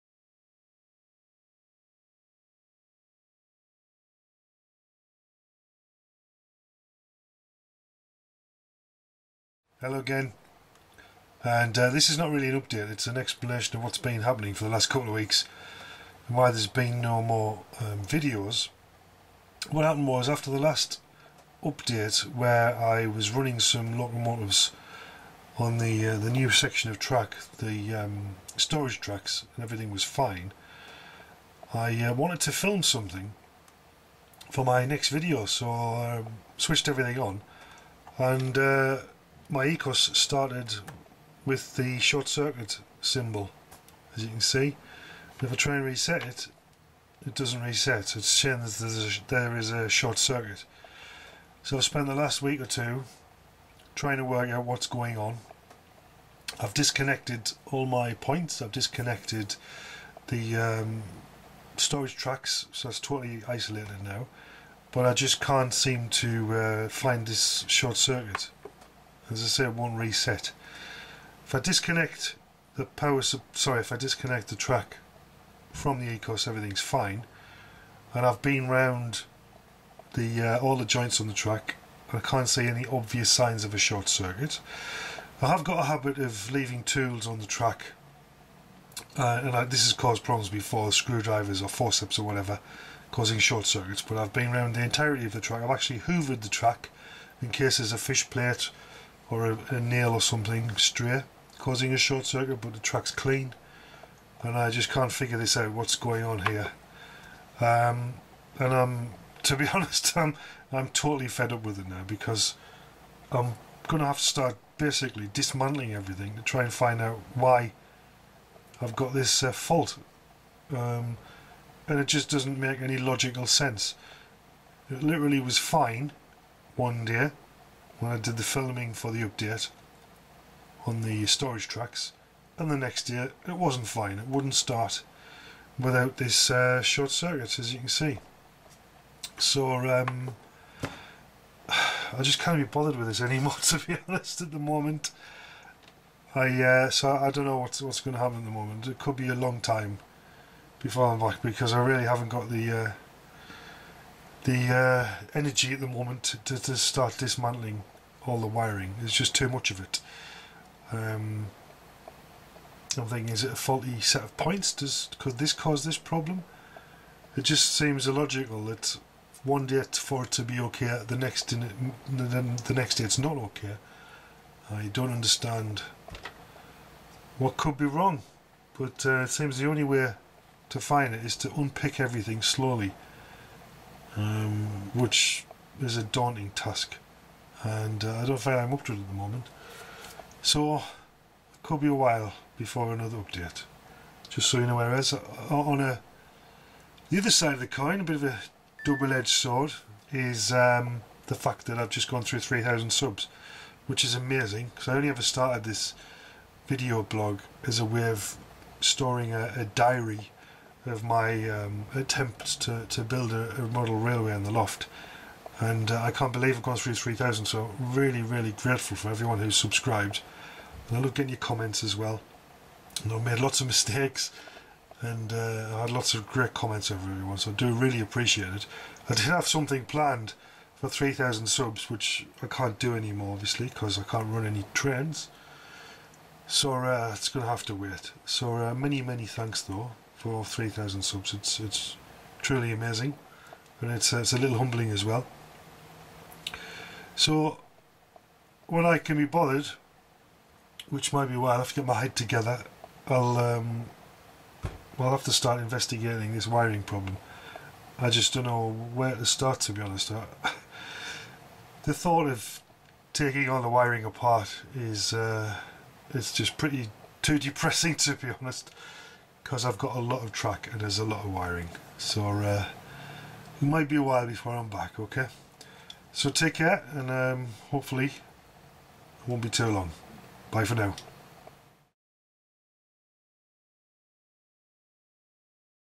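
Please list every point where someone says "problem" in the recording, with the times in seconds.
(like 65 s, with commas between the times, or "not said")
90 s, 165 s, 256 s.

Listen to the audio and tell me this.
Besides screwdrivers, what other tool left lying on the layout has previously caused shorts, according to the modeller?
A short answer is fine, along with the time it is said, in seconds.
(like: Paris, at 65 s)
forceps, at 91 s.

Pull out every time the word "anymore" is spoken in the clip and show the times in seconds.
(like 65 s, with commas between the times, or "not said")
143 s, 232 s.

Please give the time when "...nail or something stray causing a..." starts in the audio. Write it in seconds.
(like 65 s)
99 s.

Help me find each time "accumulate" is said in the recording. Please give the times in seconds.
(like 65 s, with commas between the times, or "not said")
not said.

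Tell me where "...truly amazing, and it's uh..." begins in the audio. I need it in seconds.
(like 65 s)
242 s.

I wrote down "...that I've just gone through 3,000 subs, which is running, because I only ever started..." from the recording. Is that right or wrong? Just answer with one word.
wrong.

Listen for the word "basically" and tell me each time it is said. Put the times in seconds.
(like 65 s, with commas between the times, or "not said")
114 s.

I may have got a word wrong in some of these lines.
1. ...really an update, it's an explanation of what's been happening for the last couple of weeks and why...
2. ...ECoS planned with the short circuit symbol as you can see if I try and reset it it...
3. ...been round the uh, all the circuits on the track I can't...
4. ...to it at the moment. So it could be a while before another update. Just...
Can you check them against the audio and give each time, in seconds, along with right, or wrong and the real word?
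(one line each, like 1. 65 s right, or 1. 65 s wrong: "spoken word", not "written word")
1. 12 s right
2. 39 s wrong: "started", not "planned"
3. 78 s wrong: "joints", not "circuits"
4. 188 s right.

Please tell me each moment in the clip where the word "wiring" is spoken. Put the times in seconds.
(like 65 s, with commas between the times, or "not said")
158 s, 256 s, 263 s, 271 s.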